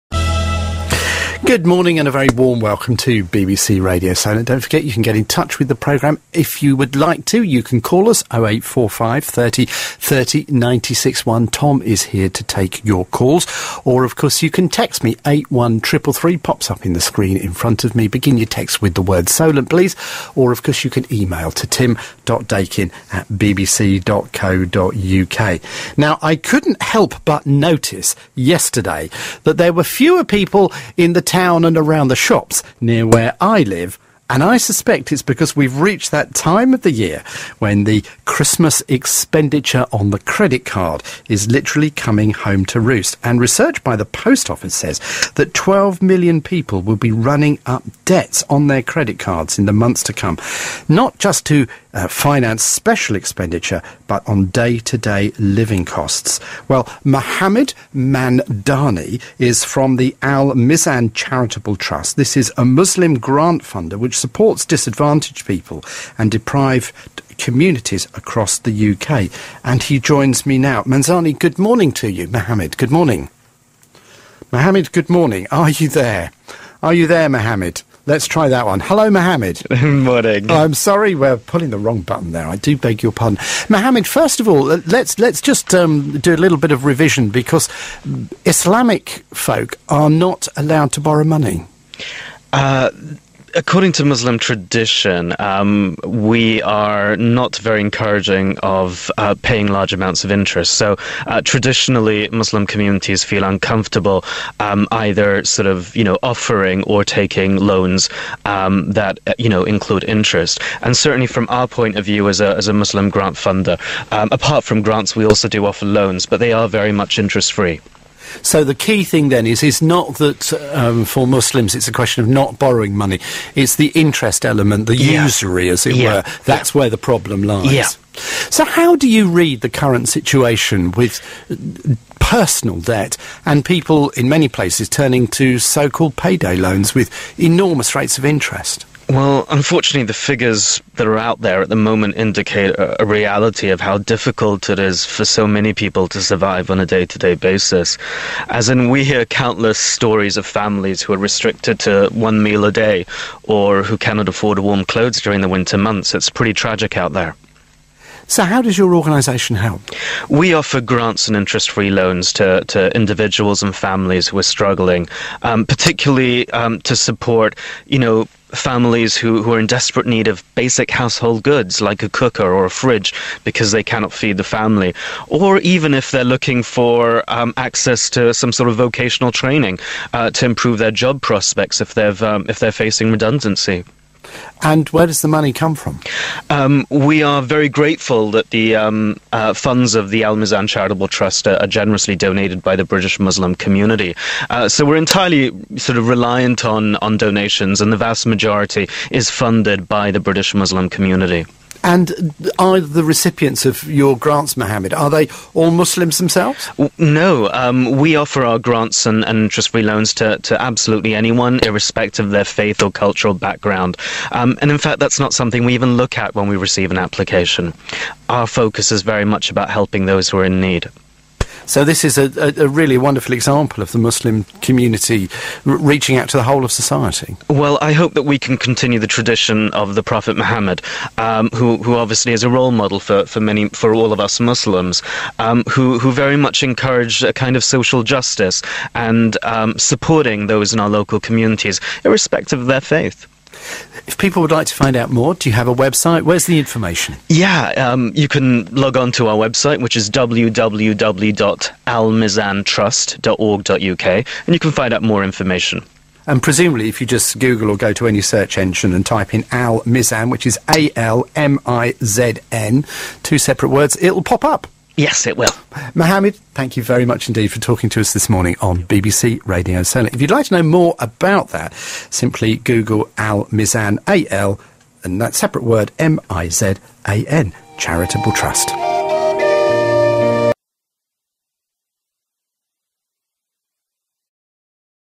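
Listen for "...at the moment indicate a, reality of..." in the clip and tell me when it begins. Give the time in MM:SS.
02:21.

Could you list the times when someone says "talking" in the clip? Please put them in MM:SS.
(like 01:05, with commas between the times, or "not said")
04:27.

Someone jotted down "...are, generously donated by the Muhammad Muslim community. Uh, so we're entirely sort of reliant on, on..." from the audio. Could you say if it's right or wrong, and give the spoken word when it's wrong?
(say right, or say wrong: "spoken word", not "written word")
wrong: "British", not "Muhammad".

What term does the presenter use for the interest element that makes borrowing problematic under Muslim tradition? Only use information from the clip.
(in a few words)
usury.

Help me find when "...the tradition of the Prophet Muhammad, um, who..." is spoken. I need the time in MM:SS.
03:48.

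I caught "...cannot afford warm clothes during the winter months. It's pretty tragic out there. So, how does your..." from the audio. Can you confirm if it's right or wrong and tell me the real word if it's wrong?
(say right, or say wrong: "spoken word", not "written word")
right.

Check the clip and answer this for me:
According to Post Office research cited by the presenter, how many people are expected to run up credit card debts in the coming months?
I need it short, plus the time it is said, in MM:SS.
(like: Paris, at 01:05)
12 million, at 00:45.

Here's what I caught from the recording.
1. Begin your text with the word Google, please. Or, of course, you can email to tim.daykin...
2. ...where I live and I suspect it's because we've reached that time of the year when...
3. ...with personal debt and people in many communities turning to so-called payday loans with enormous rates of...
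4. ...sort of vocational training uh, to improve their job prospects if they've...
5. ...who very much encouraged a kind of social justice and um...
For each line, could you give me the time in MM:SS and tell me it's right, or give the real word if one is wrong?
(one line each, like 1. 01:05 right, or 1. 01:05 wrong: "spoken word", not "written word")
1. 00:18 wrong: "Solent", not "Google"
2. 00:33 right
3. 02:10 wrong: "places", not "communities"
4. 02:58 right
5. 03:55 right.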